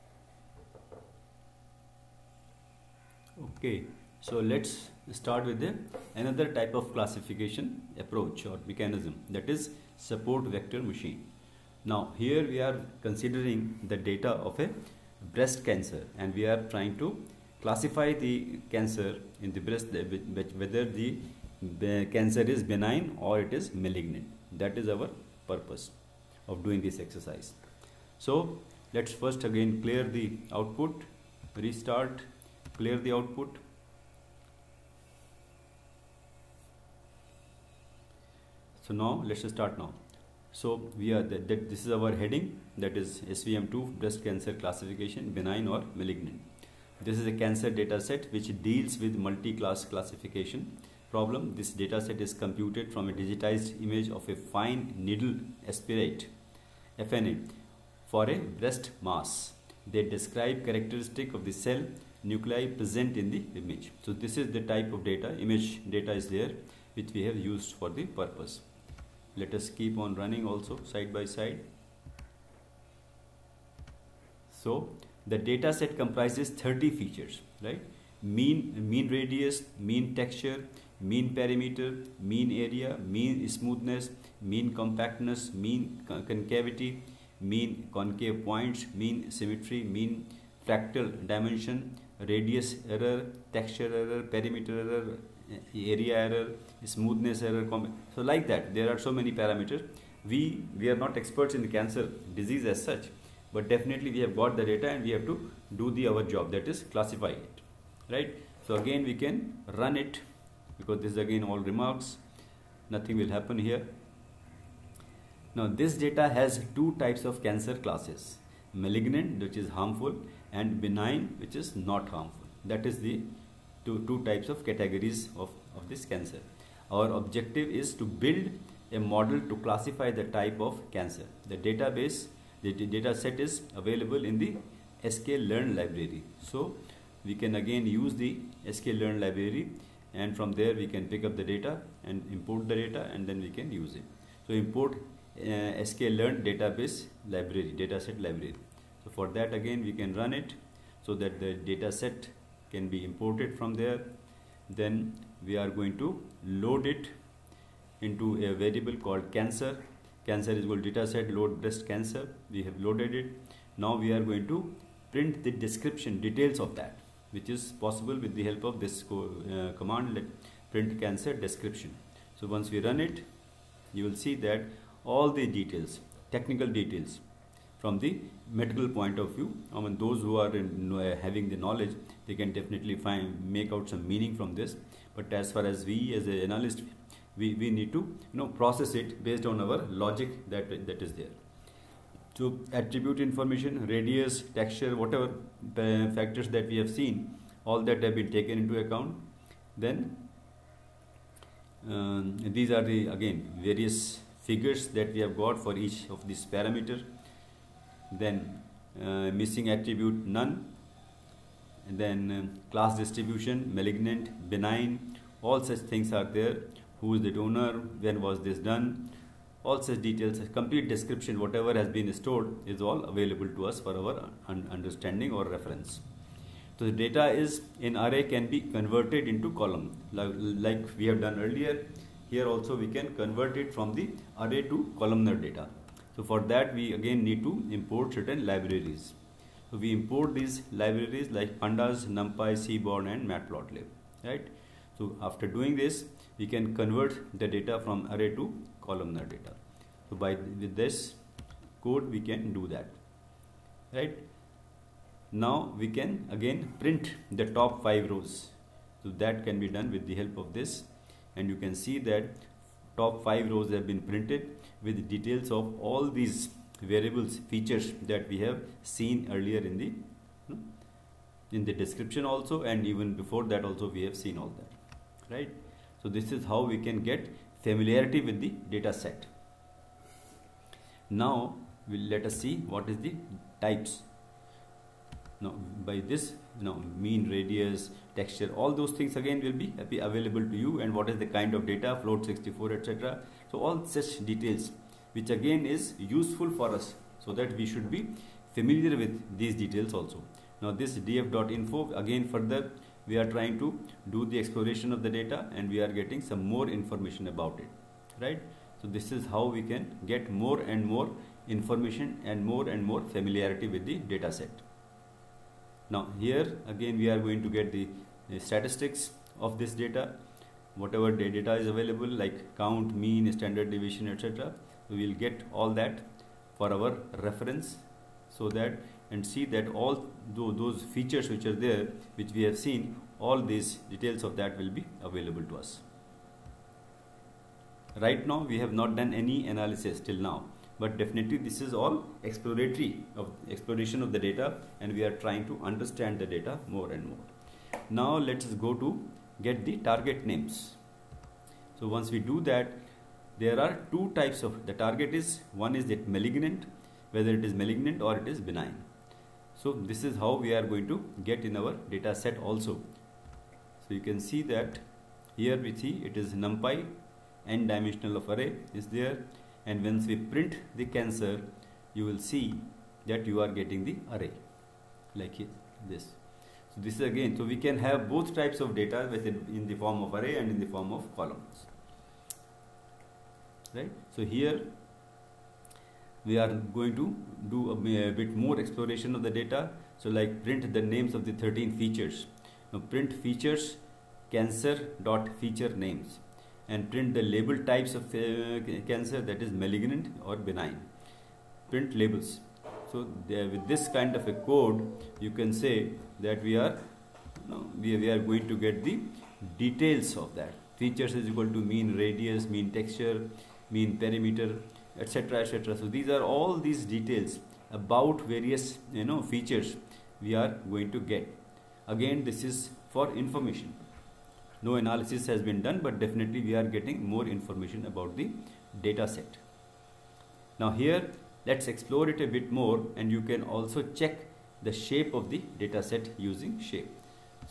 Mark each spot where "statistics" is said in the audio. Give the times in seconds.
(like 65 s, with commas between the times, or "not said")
318 s.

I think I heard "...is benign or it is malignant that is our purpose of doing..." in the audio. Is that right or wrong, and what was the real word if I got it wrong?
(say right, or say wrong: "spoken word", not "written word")
right.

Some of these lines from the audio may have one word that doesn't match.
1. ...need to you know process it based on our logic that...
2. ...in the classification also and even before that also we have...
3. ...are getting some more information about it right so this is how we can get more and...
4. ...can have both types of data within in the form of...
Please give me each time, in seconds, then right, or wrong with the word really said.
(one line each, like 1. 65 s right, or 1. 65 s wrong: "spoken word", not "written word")
1. 187 s right
2. 271 s wrong: "description", not "classification"
3. 305 s right
4. 377 s right.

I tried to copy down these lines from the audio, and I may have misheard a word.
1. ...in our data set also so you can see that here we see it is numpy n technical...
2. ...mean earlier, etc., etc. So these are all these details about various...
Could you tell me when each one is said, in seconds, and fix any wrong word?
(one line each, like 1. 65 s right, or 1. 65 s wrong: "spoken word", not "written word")
1. 361 s wrong: "dimensional", not "technical"
2. 413 s wrong: "perimeter", not "earlier".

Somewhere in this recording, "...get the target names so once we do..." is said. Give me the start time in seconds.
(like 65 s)
349 s.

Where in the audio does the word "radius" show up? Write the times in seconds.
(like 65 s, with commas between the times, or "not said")
79 s, 92 s, 193 s, 287 s, 411 s.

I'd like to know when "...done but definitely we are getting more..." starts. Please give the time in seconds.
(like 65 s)
425 s.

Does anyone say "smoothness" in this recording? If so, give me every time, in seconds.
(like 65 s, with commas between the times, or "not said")
83 s, 96 s.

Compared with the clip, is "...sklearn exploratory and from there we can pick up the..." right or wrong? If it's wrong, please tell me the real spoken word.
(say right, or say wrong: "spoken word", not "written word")
wrong: "library", not "exploratory".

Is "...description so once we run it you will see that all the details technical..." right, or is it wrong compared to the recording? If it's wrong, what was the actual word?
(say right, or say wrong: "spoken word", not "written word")
right.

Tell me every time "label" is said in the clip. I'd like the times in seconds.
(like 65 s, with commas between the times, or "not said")
397 s, 401 s.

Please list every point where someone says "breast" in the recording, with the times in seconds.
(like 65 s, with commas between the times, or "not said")
15 s, 19 s, 44 s, 58 s, 161 s.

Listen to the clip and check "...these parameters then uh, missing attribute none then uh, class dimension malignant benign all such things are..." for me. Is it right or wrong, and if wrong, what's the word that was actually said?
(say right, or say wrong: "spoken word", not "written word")
wrong: "distribution", not "dimension".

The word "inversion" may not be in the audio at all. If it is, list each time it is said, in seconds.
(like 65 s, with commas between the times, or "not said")
not said.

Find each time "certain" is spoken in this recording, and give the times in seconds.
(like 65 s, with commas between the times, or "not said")
238 s.